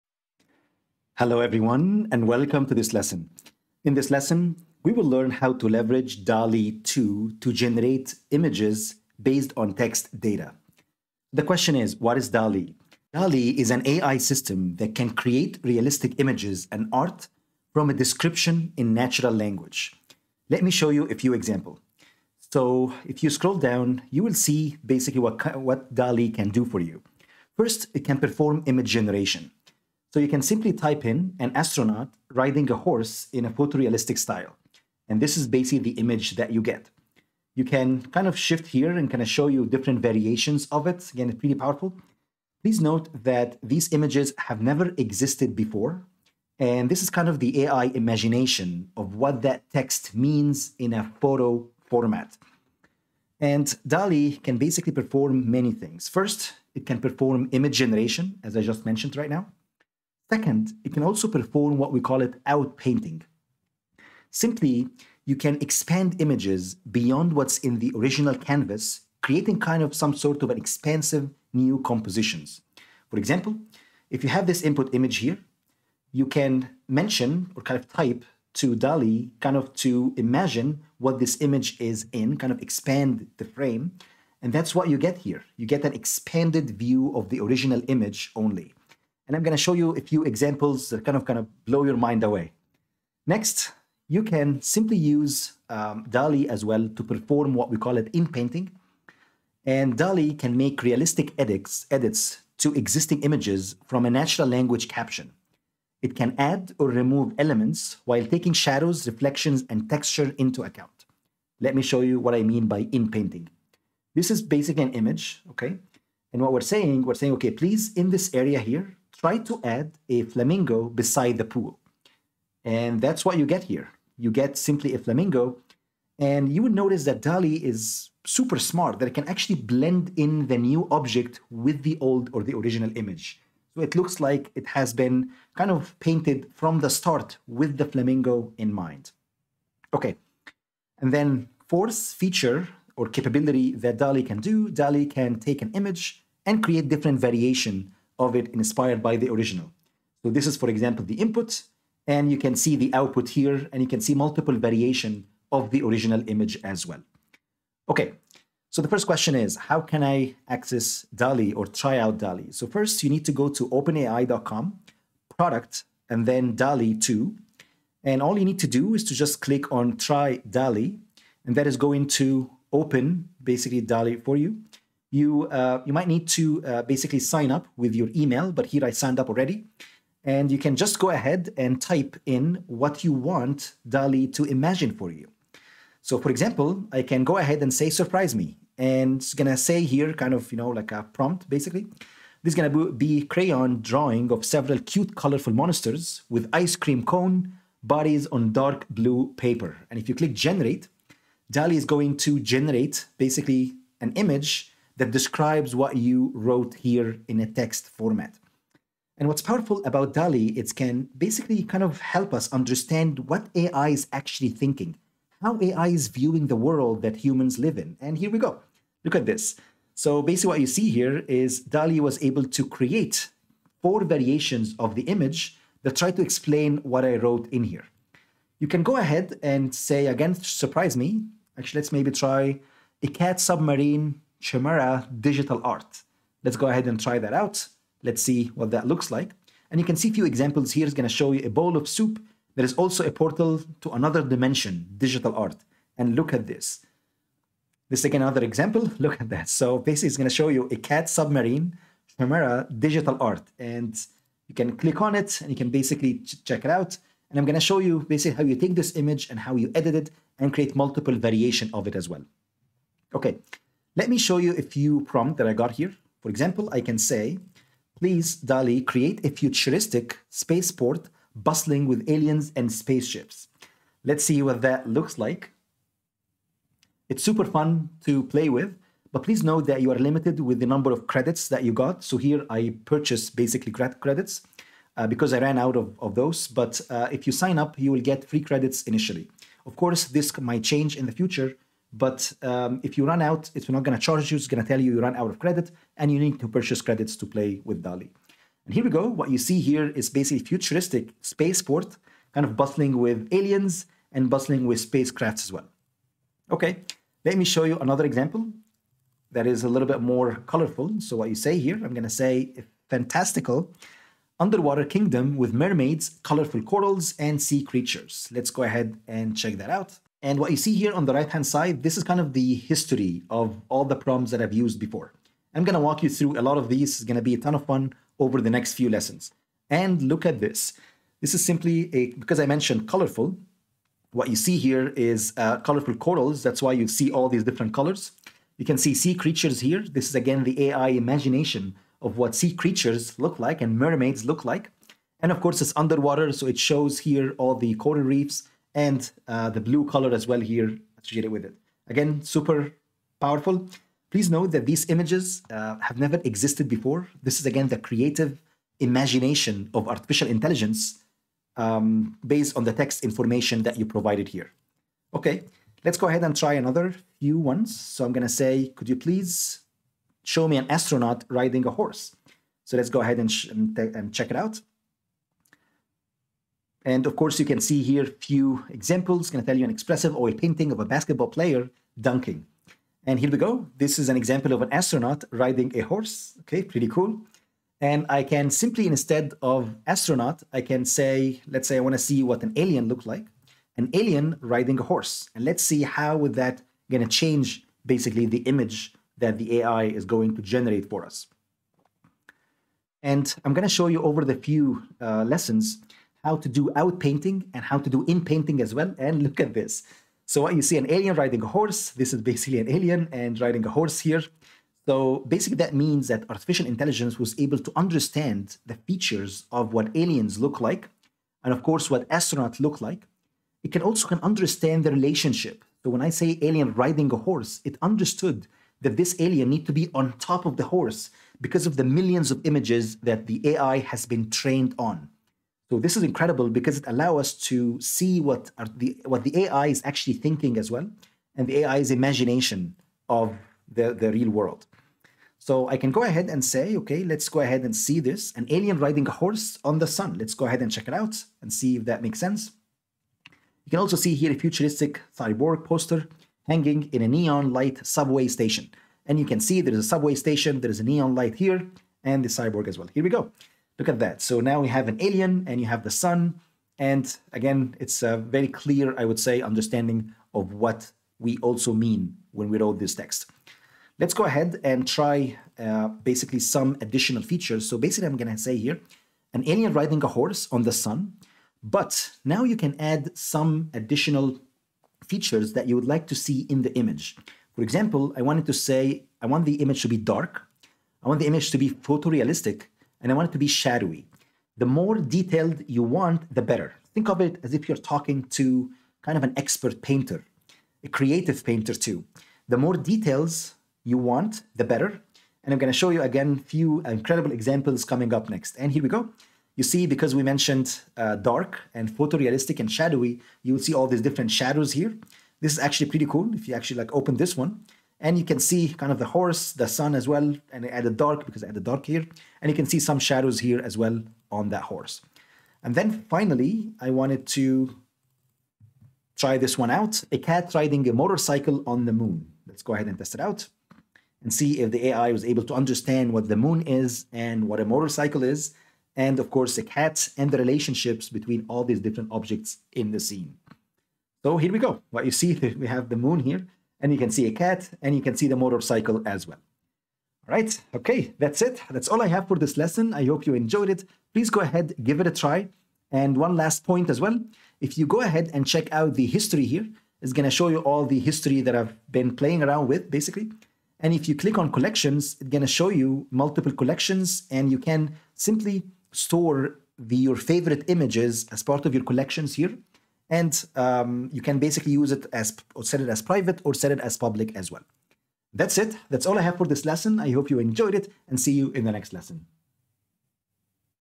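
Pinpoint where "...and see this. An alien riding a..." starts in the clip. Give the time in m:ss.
7:27.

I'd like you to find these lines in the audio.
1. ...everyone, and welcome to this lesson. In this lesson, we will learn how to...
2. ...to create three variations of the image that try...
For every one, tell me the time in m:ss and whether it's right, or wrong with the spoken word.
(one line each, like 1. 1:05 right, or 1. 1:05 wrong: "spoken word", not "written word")
1. 0:01 right
2. 3:42 wrong: "four", not "three".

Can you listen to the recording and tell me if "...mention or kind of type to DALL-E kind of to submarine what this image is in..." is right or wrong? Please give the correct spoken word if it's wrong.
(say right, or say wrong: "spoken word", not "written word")
wrong: "imagine", not "submarine".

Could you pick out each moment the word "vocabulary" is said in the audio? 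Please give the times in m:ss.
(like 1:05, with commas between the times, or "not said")
not said.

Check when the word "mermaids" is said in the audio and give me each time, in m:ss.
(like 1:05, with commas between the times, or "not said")
5:15, 5:43.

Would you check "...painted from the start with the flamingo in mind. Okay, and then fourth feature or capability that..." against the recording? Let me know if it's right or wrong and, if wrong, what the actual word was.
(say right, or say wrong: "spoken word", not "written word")
right.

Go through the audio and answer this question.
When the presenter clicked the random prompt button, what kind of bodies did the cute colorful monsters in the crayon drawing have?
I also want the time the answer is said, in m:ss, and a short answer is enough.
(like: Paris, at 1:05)
ice cream cone bodies, at 3:16.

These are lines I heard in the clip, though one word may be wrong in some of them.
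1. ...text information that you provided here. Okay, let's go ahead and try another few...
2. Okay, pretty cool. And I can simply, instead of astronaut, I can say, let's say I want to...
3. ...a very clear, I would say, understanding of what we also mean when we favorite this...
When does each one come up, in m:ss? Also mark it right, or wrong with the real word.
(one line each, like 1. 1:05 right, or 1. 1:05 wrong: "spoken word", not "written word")
1. 6:02 right
2. 6:26 right
3. 7:48 wrong: "wrote", not "favorite".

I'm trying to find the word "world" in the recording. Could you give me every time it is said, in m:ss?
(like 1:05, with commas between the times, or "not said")
3:36, 7:24.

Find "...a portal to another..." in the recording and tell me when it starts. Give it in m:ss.
4:03.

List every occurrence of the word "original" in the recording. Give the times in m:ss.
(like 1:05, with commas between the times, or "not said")
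1:07, 1:27, 2:12, 2:29, 2:35.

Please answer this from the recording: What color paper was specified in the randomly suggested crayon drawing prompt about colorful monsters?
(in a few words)
dark blue.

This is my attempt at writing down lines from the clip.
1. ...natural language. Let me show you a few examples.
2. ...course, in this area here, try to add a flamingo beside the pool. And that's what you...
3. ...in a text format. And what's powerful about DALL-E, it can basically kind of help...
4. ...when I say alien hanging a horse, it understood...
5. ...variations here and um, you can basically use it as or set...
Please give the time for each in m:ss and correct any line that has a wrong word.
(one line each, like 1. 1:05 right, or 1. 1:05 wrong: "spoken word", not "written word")
1. 0:18 right
2. 1:57 wrong: "please", not "course"
3. 3:27 right
4. 7:05 wrong: "riding", not "hanging"
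5. 9:31 wrong: "collections", not "variations".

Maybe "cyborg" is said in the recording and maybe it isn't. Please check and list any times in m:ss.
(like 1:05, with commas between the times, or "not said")
7:35, 7:42.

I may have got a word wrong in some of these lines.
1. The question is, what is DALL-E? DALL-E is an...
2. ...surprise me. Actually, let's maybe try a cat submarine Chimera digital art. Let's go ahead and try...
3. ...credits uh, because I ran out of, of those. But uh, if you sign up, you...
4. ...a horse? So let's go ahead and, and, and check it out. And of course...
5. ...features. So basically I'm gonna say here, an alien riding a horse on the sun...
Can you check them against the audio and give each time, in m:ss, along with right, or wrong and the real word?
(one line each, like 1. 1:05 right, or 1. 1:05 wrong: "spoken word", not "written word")
1. 0:11 right
2. 3:50 right
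3. 4:43 right
4. 6:11 right
5. 7:57 right.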